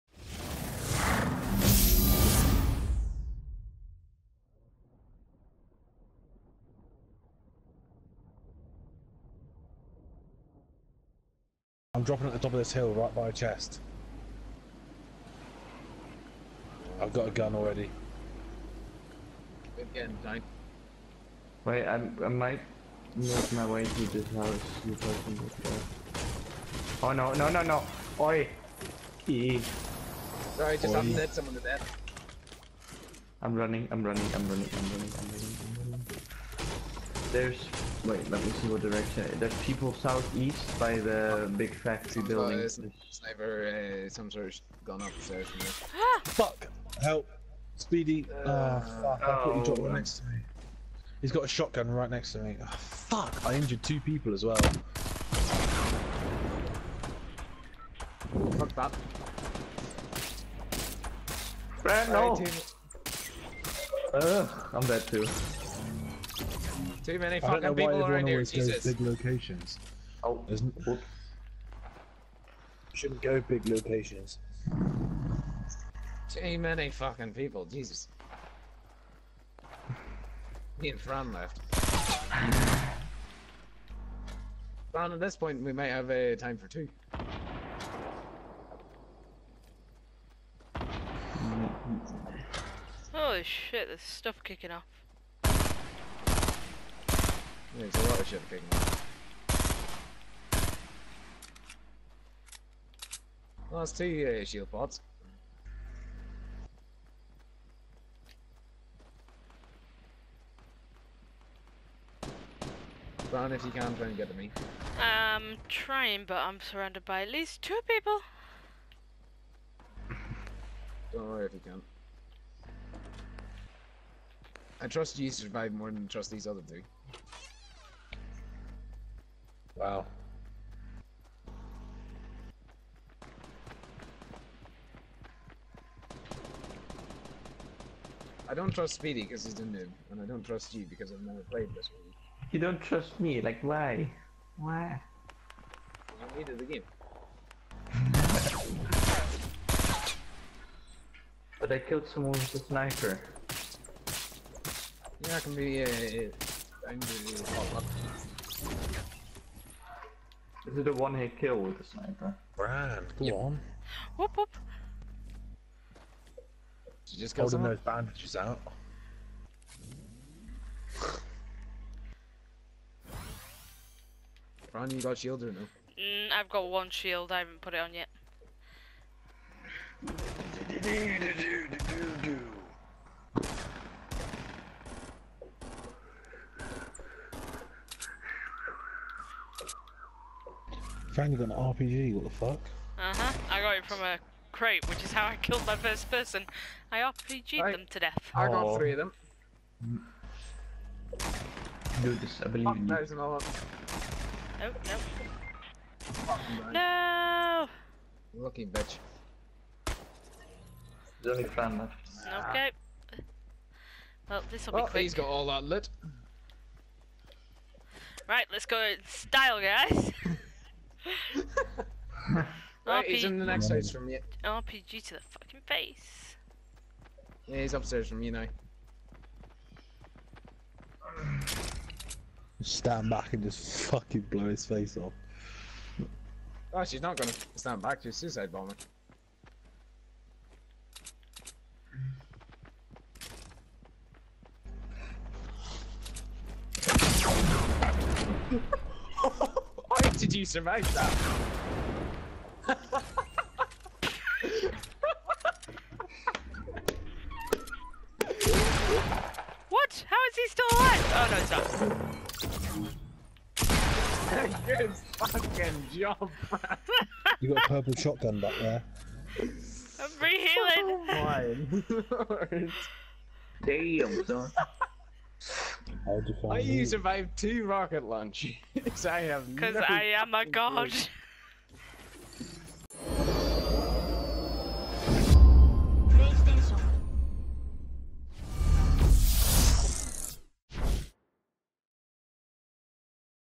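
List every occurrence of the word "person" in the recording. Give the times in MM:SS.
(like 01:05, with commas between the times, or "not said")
03:16.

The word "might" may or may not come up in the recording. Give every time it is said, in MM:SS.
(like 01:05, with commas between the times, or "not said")
00:22, 01:25.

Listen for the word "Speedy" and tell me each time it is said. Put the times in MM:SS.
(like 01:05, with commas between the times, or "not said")
00:47, 02:18.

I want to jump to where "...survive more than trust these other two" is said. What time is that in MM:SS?
02:05.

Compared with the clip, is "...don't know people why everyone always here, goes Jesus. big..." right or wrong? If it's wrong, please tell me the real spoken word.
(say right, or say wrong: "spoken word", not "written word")
right.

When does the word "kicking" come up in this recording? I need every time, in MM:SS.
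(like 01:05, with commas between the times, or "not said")
01:34, 01:38.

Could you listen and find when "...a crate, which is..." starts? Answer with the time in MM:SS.
03:13.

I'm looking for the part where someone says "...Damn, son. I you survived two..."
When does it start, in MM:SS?
04:33.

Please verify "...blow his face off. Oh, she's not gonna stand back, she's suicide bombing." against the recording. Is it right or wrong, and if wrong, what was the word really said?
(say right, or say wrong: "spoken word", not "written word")
right.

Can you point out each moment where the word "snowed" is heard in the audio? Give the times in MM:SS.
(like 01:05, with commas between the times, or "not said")
not said.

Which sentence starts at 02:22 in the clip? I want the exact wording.
You don't trust me, like why?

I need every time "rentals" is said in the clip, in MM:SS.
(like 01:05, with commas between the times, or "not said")
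not said.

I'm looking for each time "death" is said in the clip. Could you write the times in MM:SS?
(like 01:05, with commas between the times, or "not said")
00:31, 03:17.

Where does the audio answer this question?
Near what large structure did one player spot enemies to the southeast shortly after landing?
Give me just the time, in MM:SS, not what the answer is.
00:41.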